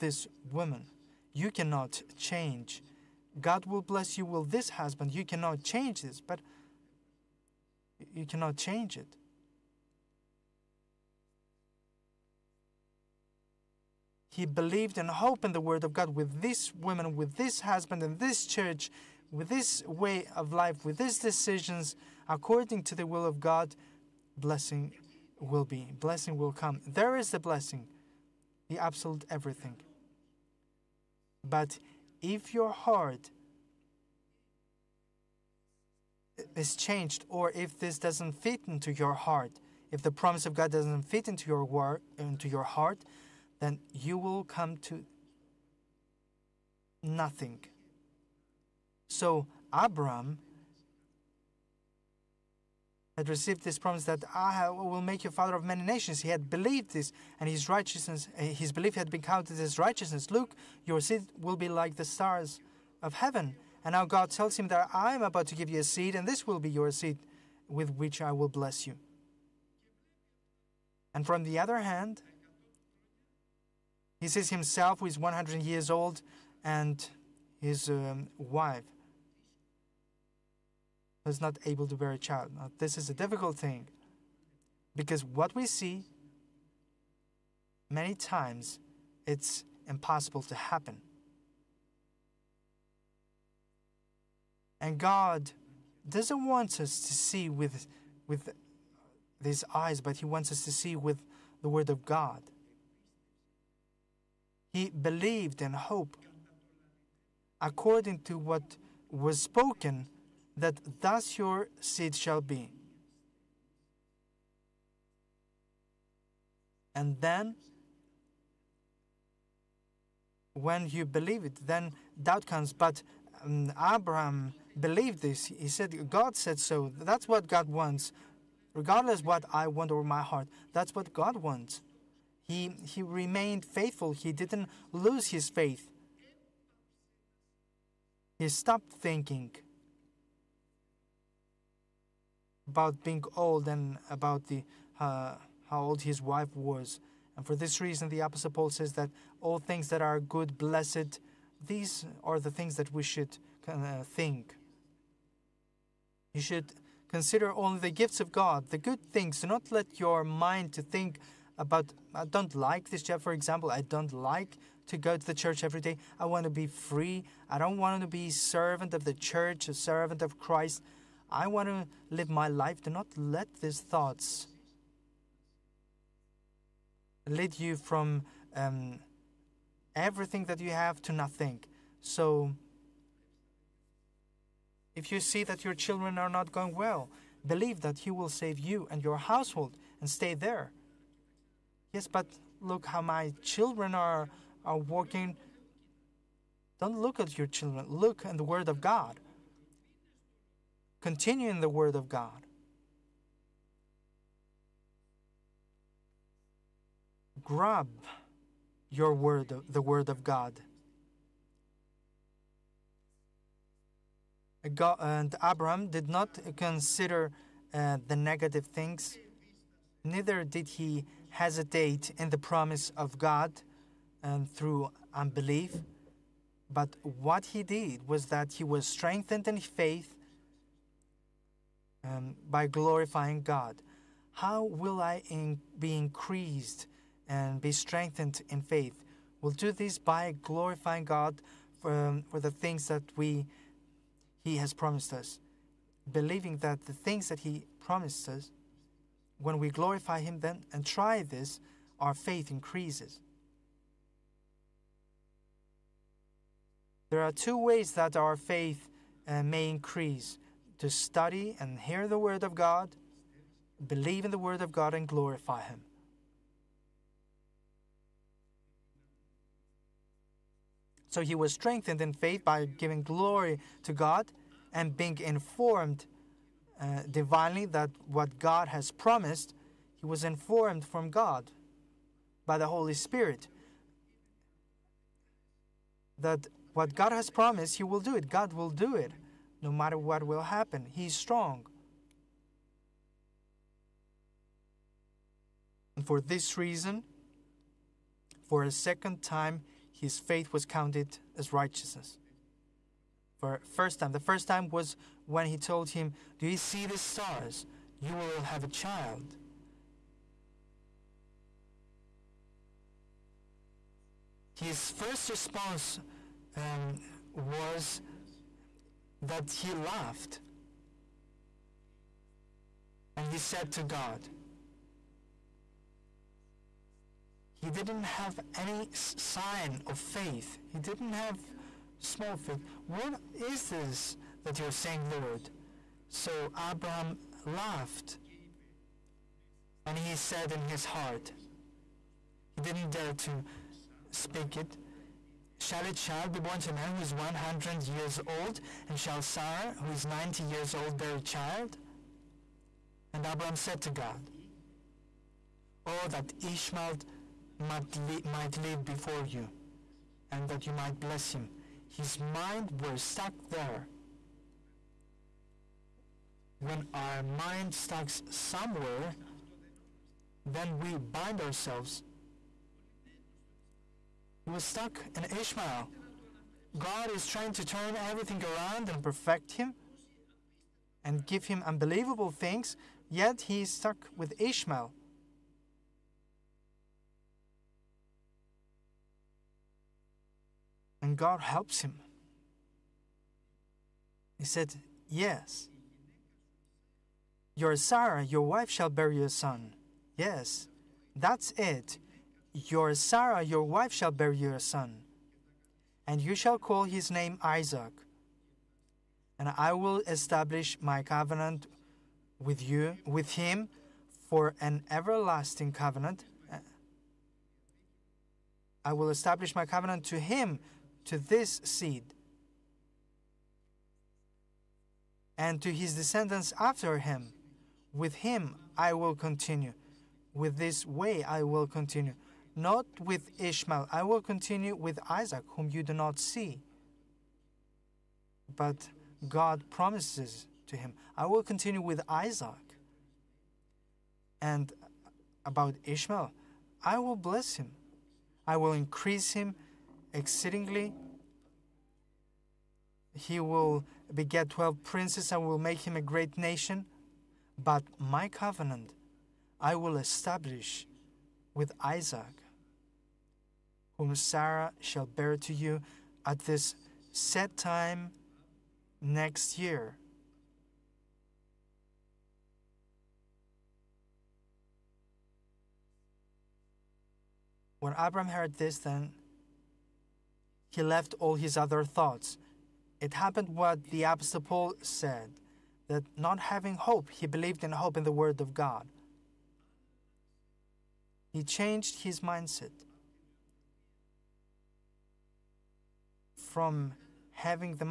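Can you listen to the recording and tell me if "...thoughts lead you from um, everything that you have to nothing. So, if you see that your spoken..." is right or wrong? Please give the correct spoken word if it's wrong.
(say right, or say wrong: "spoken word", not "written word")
wrong: "children", not "spoken".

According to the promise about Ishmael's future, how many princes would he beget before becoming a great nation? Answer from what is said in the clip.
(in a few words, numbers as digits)
12.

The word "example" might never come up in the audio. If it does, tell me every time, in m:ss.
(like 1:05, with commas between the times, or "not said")
2:43.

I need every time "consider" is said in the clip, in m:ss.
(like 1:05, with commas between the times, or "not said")
2:37, 3:36.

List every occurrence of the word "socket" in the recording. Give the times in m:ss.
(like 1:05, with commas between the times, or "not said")
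not said.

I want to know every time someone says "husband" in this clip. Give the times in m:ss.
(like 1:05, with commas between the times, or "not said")
0:04, 0:17.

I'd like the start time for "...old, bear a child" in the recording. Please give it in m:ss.
5:50.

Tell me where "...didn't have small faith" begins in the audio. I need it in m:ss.
5:30.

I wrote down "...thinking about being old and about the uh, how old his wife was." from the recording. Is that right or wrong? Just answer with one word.
right.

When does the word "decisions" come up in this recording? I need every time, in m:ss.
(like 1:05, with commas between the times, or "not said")
0:21.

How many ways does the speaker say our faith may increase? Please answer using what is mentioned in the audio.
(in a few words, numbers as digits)
2.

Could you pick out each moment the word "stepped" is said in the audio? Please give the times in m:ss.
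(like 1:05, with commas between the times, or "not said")
not said.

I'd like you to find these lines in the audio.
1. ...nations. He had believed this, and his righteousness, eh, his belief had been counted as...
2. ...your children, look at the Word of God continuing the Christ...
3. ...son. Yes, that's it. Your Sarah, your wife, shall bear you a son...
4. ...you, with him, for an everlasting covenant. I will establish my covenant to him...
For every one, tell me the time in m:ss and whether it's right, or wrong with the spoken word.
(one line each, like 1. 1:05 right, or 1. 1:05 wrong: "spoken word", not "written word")
1. 0:55 right
2. 3:17 wrong: "Word", not "Christ"
3. 6:39 right
4. 6:52 right.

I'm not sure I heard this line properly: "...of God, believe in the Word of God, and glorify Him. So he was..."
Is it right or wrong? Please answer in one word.
right.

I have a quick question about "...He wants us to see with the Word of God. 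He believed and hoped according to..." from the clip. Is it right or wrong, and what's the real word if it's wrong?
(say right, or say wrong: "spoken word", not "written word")
right.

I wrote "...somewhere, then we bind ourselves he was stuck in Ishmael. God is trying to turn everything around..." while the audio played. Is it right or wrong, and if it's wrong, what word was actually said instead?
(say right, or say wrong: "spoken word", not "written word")
right.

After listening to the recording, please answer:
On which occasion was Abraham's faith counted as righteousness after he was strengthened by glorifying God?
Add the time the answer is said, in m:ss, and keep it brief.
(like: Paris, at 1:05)
Second time, at 4:58.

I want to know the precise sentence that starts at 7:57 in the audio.
When Abram heard this, then he left all his other thoughts.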